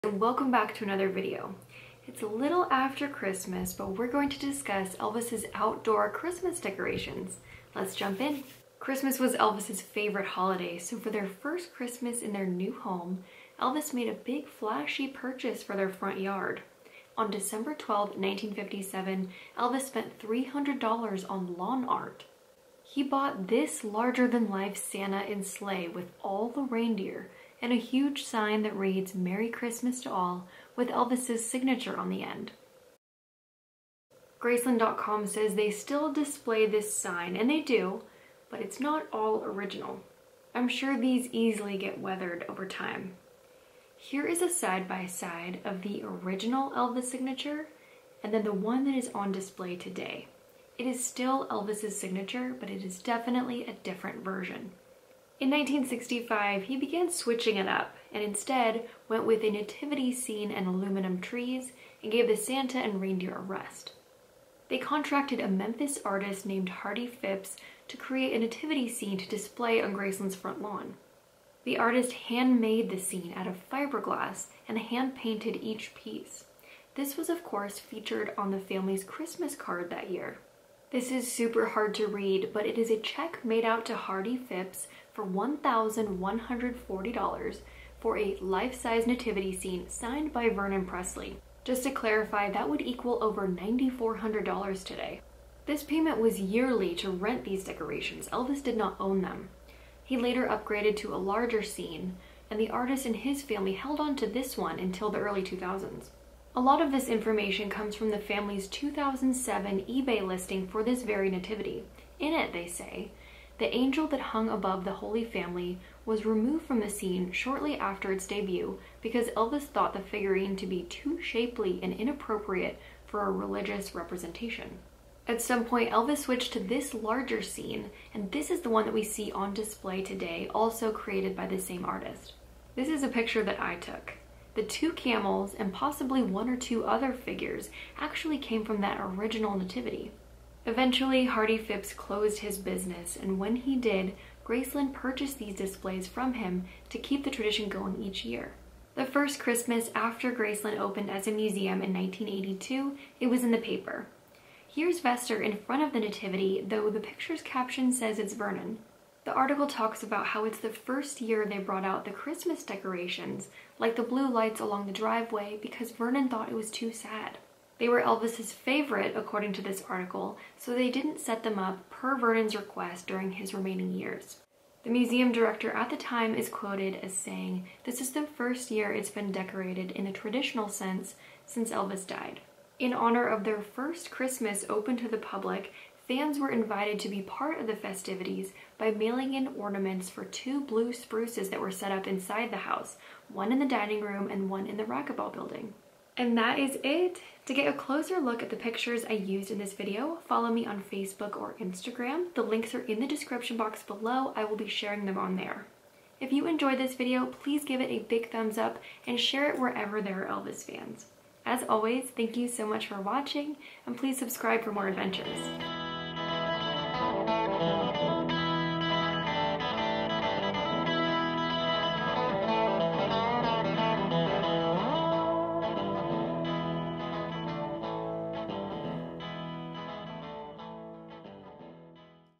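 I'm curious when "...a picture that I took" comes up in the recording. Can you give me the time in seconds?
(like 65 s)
133 s.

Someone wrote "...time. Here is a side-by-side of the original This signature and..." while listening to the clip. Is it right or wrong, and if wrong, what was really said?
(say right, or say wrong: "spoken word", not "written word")
wrong: "Elvis", not "This".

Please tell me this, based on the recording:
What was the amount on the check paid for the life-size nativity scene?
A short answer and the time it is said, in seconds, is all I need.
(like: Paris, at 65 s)
$1,140, at 85 s.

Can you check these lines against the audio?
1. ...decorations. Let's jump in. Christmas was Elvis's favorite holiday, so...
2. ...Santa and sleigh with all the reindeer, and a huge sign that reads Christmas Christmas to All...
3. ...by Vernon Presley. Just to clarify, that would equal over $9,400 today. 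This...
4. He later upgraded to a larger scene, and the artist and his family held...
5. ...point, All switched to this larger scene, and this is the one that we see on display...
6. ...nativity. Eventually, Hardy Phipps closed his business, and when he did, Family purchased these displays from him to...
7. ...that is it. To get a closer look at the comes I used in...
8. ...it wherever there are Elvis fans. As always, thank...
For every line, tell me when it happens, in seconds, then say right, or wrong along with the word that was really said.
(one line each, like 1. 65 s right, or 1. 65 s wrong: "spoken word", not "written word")
1. 6 s right
2. 24 s wrong: "Merry", not "Christmas"
3. 90 s right
4. 100 s right
5. 125 s wrong: "Elvis", not "All"
6. 139 s wrong: "Graceland", not "Family"
7. 196 s wrong: "pictures", not "comes"
8. 209 s right.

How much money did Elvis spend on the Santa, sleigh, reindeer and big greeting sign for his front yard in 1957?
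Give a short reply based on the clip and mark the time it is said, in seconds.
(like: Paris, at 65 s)
$300, at 20 s.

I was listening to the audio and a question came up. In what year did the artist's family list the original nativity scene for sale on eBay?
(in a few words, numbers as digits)
2007.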